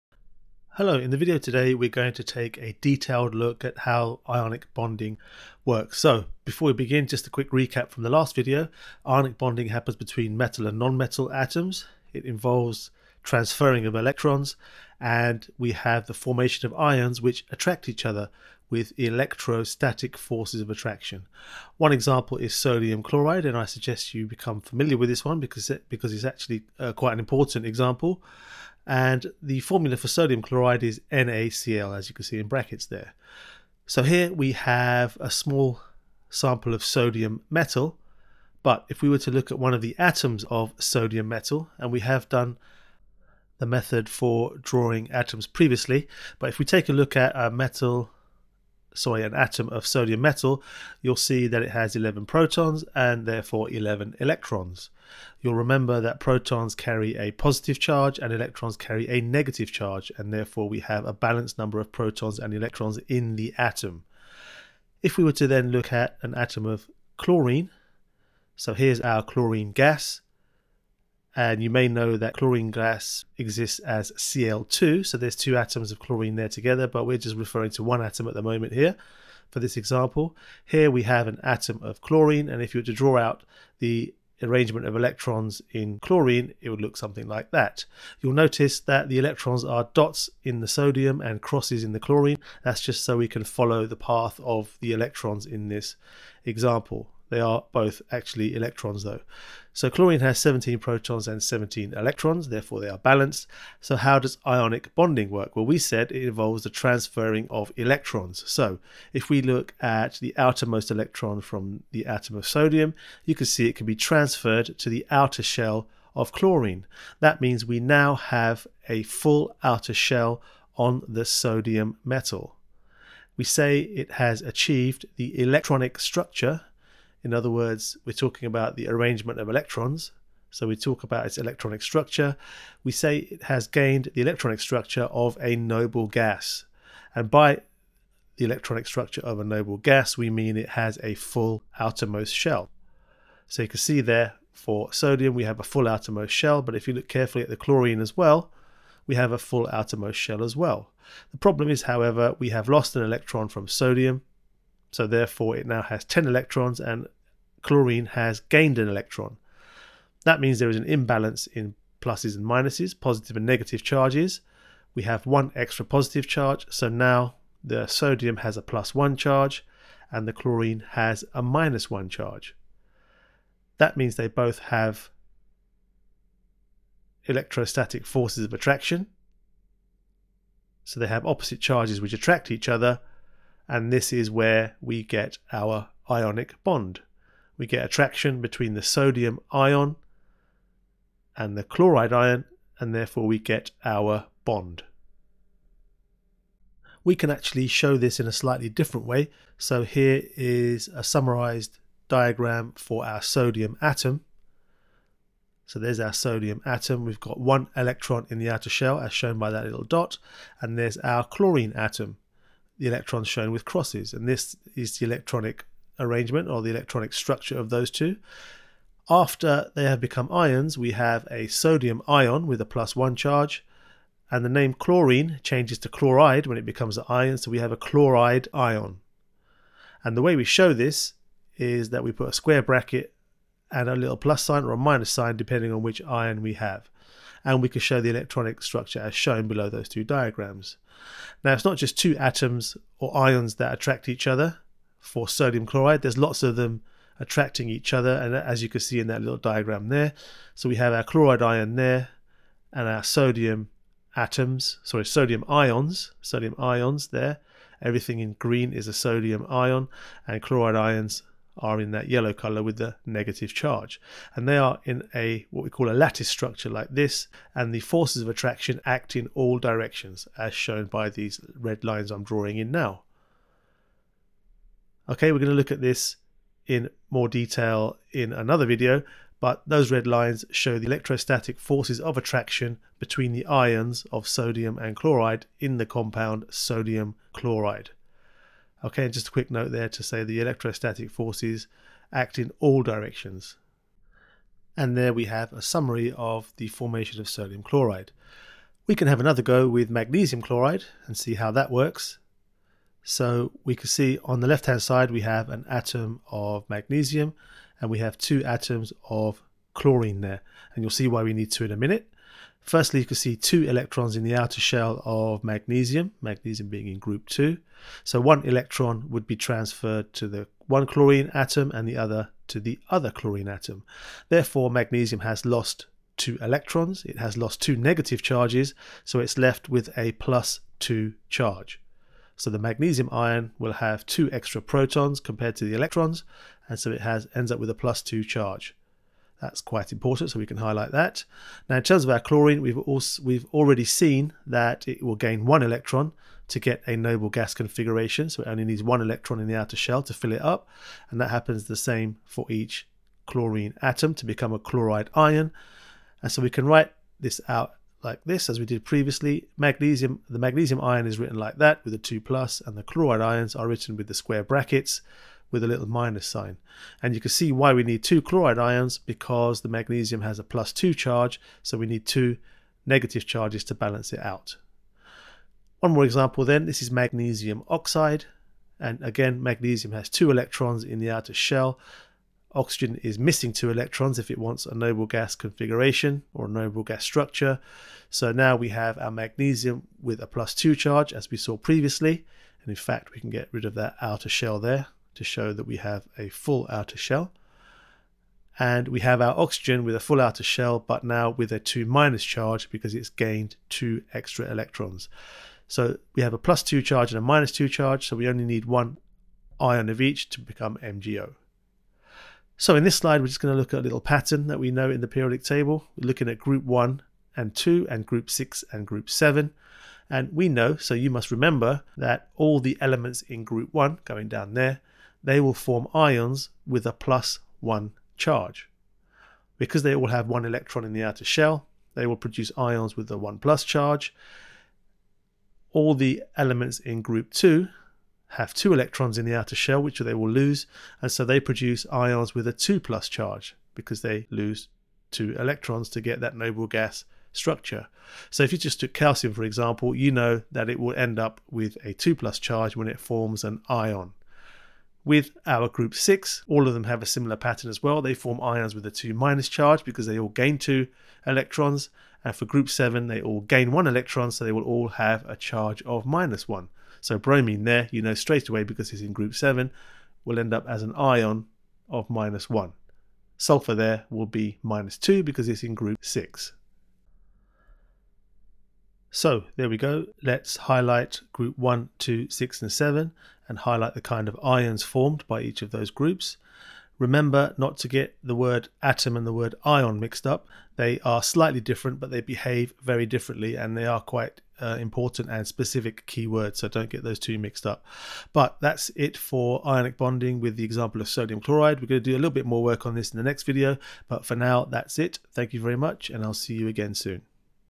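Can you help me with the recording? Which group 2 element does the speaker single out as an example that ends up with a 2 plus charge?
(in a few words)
calcium.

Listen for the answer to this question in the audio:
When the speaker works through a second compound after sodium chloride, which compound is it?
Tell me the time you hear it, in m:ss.
4:59.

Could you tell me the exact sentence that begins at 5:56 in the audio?
And so we can write this out like this, as we did previously.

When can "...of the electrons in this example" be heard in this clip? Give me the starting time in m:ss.
1:34.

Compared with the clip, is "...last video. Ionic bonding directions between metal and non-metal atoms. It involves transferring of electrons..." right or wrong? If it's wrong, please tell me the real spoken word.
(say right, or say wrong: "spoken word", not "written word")
wrong: "happens", not "directions".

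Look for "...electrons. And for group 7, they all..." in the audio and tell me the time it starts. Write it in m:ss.
7:41.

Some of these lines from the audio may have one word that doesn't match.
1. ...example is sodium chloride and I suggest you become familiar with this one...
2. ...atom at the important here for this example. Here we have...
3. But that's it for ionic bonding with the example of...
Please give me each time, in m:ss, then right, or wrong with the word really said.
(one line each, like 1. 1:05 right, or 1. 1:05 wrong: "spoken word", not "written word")
1. 0:21 right
2. 1:18 wrong: "moment", not "important"
3. 8:18 right.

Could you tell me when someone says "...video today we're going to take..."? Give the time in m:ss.
0:01.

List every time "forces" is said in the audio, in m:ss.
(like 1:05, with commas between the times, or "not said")
0:20, 2:58, 4:27, 4:41, 4:51.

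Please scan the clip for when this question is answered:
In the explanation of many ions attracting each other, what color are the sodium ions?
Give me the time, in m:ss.
4:18.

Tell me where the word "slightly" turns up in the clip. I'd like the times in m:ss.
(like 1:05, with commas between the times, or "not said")
3:18, 8:11.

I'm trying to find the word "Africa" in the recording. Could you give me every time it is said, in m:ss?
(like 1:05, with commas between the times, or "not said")
not said.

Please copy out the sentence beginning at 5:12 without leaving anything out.
Firstly you can see two electrons in the outer shell of magnesium, magnesium being in group 2.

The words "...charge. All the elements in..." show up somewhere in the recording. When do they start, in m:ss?
7:13.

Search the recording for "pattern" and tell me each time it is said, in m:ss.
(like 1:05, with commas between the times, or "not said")
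6:53, 7:37.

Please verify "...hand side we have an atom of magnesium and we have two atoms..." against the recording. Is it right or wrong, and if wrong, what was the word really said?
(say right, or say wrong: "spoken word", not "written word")
right.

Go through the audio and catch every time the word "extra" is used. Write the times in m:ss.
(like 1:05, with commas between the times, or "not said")
2:45, 5:34, 6:44.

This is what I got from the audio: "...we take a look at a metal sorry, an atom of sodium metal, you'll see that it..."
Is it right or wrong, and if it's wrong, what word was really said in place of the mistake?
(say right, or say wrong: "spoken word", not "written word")
right.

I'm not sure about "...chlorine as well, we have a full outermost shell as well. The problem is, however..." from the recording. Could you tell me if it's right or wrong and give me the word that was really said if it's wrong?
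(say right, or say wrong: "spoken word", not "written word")
right.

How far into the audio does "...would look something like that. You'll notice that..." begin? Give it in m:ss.
1:26.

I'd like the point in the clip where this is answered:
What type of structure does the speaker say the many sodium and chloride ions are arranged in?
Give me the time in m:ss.
4:25.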